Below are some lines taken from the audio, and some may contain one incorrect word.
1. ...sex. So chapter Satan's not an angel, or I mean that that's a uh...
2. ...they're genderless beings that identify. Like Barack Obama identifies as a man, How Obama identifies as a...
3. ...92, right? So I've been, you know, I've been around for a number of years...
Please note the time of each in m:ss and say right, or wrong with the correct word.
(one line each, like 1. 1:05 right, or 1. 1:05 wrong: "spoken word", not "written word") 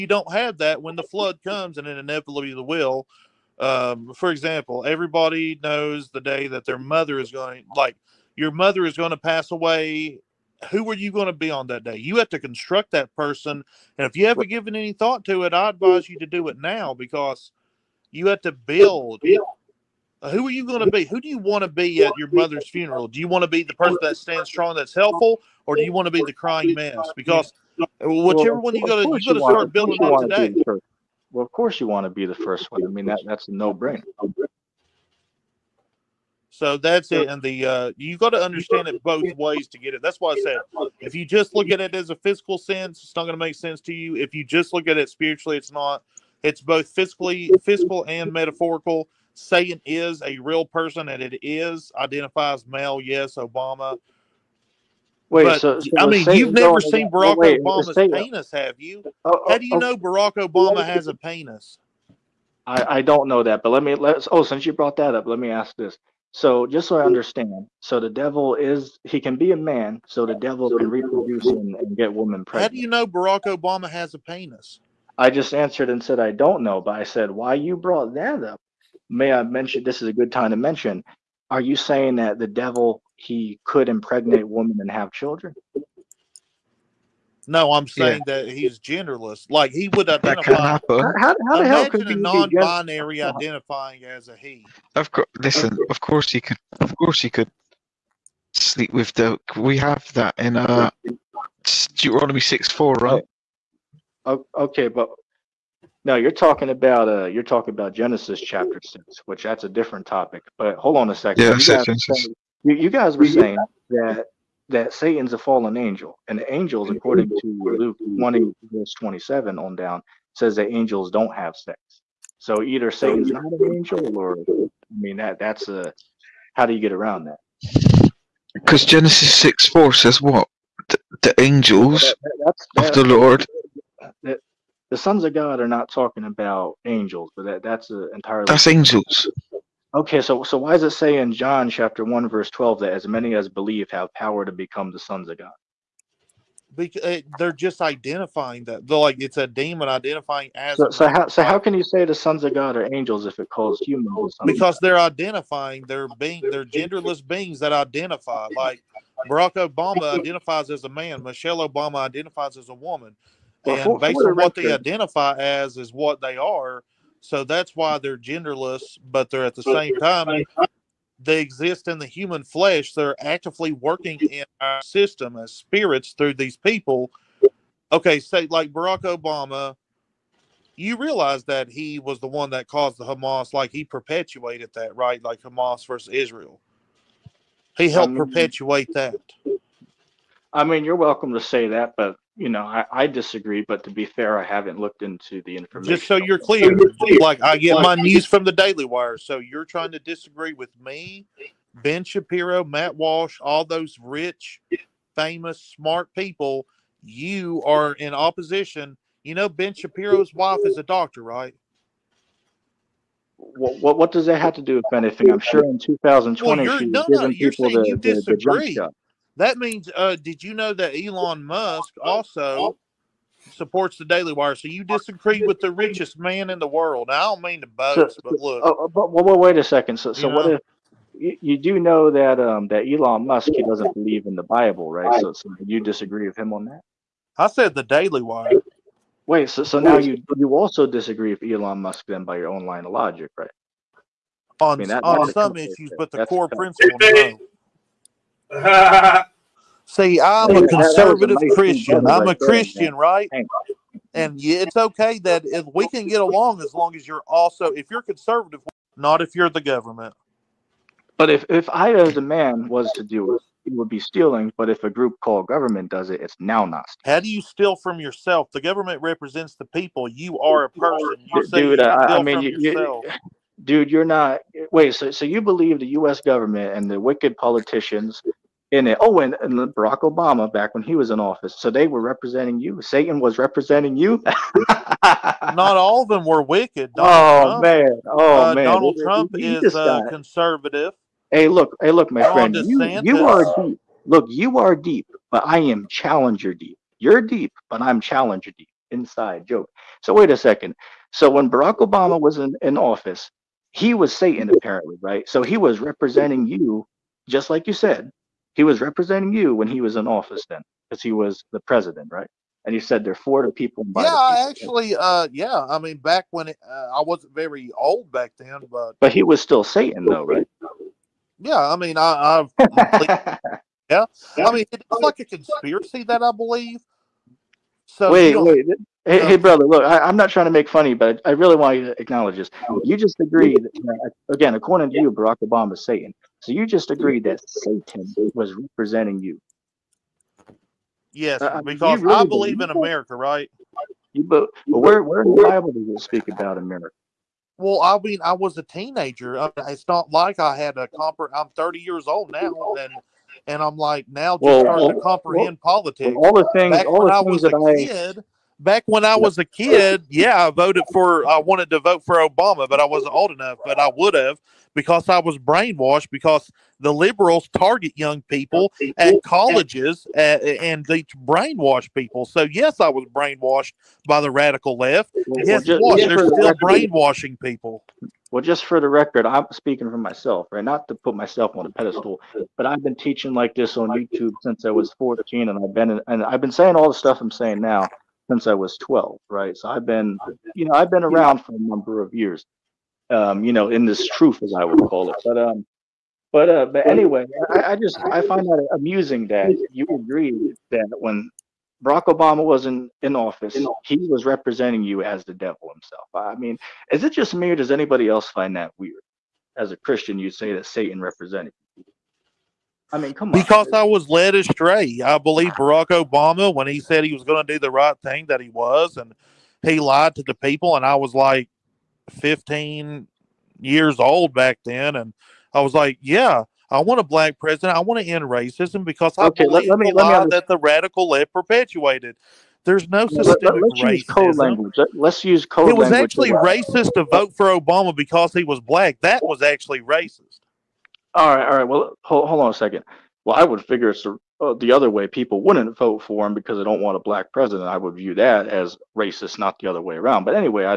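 1. 2:01 wrong: "either", not "chapter"
2. 2:36 wrong: "Michelle", not "How"
3. 6:28 wrong: "12", not "92".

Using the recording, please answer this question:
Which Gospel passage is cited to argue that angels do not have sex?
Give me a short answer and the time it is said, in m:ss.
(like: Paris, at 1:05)
Luke 20:27, at 1:57.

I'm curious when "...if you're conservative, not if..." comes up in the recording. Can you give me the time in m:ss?
4:17.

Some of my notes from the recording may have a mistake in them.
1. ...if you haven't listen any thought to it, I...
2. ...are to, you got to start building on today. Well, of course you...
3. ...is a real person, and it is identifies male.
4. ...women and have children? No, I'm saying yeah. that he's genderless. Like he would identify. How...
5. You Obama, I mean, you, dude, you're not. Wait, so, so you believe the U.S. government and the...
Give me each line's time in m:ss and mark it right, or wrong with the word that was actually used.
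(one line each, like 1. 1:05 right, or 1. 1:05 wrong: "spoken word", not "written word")
1. 0:14 wrong: "given", not "listen"
2. 0:28 right
3. 0:49 right
4. 1:24 right
5. 4:31 wrong: "Dude", not "Obama".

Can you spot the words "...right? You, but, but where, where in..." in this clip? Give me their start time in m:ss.
5:43.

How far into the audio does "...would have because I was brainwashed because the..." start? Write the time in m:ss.
6:03.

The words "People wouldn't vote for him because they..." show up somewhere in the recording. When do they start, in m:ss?
7:25.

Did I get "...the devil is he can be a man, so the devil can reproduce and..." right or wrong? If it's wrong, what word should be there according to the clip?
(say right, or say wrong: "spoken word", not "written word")
right.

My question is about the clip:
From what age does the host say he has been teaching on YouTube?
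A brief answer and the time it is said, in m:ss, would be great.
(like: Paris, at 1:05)
14, at 6:24.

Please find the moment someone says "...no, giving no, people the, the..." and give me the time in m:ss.
3:36.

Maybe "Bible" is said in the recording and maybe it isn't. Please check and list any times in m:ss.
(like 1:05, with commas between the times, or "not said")
3:54, 5:45.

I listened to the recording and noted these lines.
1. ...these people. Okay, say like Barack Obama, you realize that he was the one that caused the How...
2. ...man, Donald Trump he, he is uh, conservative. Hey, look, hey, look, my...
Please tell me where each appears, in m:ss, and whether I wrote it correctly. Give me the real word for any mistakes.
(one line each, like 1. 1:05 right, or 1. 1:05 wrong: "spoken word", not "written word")
1. 2:56 wrong: "Hamas", not "How"
2. 4:48 right.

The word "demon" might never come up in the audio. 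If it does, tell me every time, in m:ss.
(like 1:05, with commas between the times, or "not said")
2:29.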